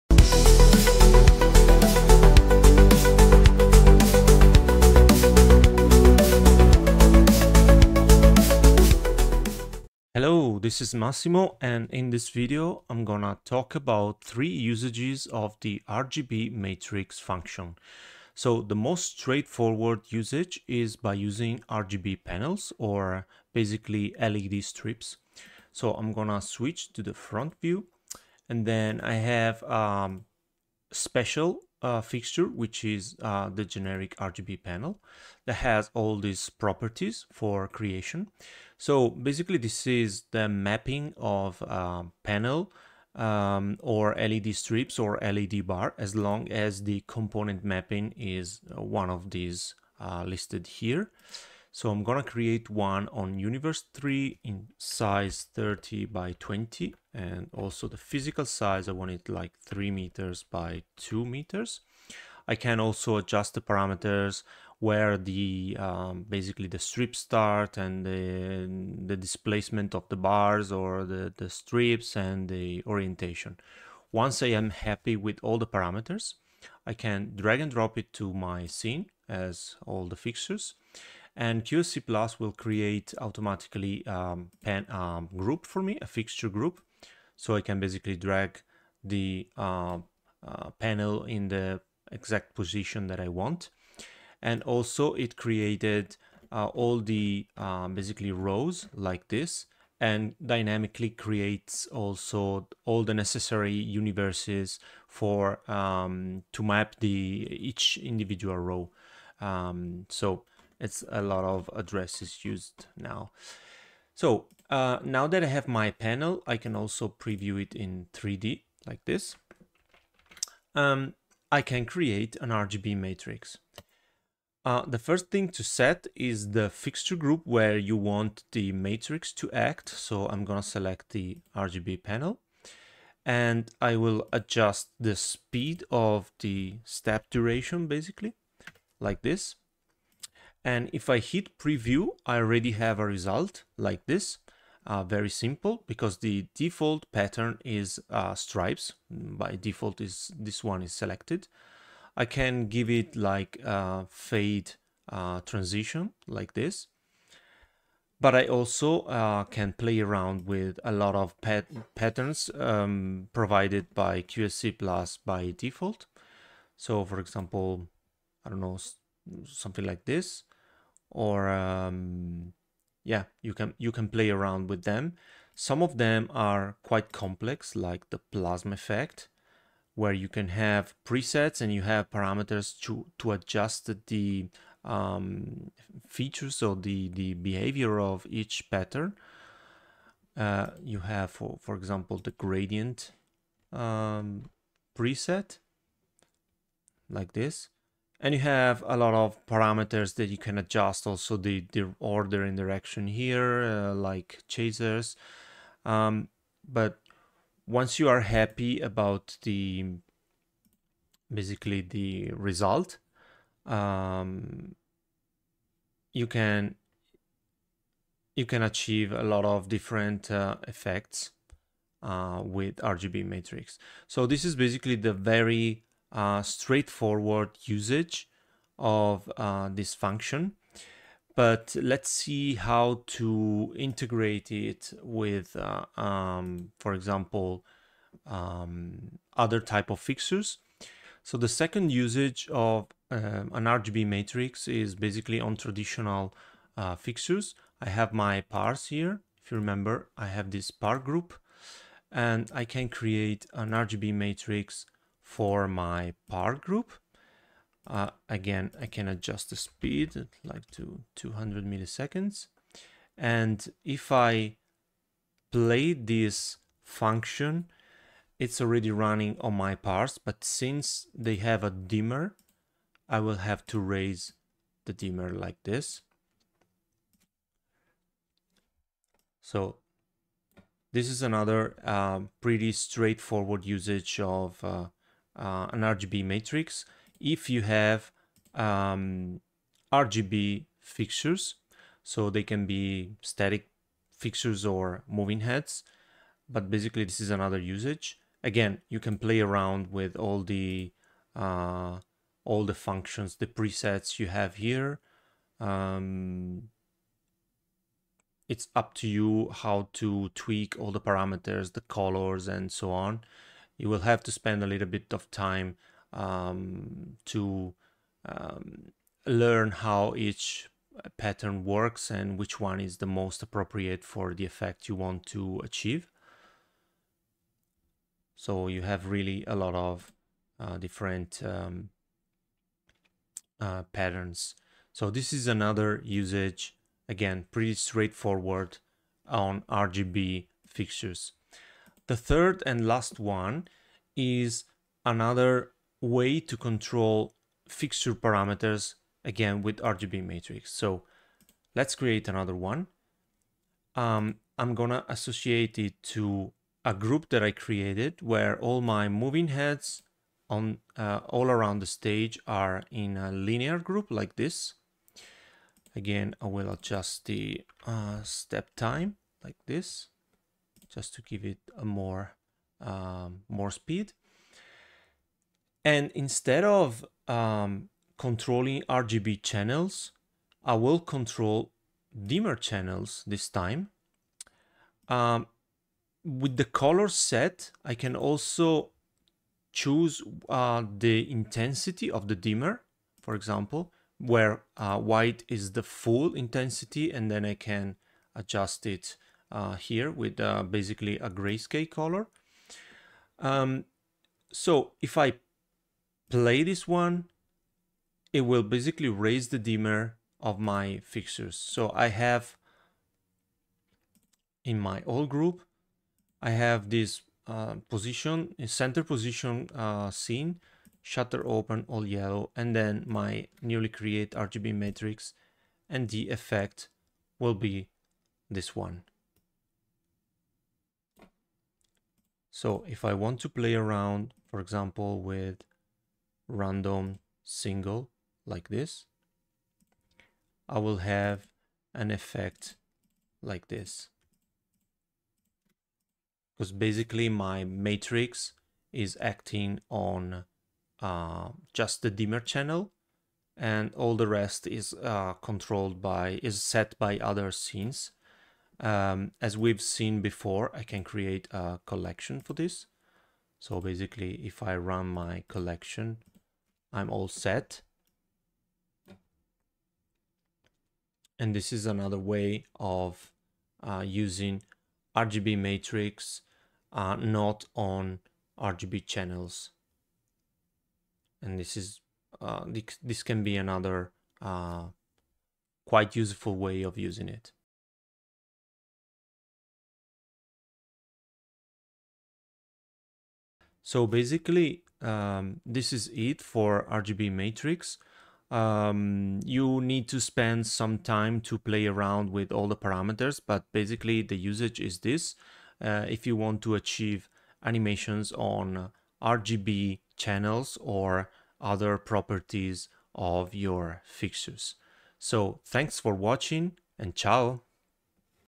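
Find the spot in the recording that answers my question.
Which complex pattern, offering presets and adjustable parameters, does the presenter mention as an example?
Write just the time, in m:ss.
2:58.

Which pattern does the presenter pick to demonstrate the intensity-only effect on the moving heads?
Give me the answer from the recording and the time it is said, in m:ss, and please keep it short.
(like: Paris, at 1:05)
Random single, at 7:16.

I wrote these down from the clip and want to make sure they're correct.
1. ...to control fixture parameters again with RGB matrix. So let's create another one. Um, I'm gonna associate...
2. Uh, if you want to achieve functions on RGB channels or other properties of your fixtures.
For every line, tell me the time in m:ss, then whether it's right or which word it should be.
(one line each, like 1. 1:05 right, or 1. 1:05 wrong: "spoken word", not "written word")
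1. 5:46 right
2. 8:25 wrong: "animations", not "functions".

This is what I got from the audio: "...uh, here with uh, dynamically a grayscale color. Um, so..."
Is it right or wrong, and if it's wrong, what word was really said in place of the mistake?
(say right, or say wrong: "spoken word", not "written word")
wrong: "basically", not "dynamically".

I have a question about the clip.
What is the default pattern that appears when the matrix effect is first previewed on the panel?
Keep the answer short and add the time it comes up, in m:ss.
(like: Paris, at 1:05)
Stripes, at 2:28.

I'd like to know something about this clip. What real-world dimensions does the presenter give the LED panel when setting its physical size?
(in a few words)
3 meters by 2 meters.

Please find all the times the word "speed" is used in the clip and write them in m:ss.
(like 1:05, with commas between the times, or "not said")
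2:15, 4:19, 6:13.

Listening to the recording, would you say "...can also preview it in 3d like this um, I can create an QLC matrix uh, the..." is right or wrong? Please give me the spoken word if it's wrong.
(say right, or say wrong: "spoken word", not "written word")
wrong: "RGB", not "QLC".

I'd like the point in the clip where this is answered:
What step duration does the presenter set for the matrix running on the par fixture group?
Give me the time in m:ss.
4:21.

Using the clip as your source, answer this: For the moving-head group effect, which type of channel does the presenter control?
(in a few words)
Dimmer channels.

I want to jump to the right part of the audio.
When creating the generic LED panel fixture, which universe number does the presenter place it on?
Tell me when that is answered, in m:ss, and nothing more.
0:53.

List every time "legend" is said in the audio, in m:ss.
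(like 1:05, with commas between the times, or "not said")
not said.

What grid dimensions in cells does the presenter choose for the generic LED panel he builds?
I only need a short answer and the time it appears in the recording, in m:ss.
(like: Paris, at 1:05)
30 by 20, at 0:55.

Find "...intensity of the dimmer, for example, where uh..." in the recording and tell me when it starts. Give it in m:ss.
6:31.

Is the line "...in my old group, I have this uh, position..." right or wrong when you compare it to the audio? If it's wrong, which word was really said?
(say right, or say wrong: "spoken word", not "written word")
right.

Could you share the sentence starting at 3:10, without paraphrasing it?
Uh, you have, for, for example, the gradient um, preset like this.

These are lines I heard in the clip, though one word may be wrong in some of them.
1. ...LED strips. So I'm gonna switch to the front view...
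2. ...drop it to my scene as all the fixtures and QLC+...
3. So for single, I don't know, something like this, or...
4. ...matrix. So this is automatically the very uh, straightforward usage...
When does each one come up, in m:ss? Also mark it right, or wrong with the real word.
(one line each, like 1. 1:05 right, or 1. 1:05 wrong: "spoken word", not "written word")
1. 0:24 right
2. 1:17 right
3. 2:46 wrong: "example", not "single"
4. 3:43 wrong: "basically", not "automatically".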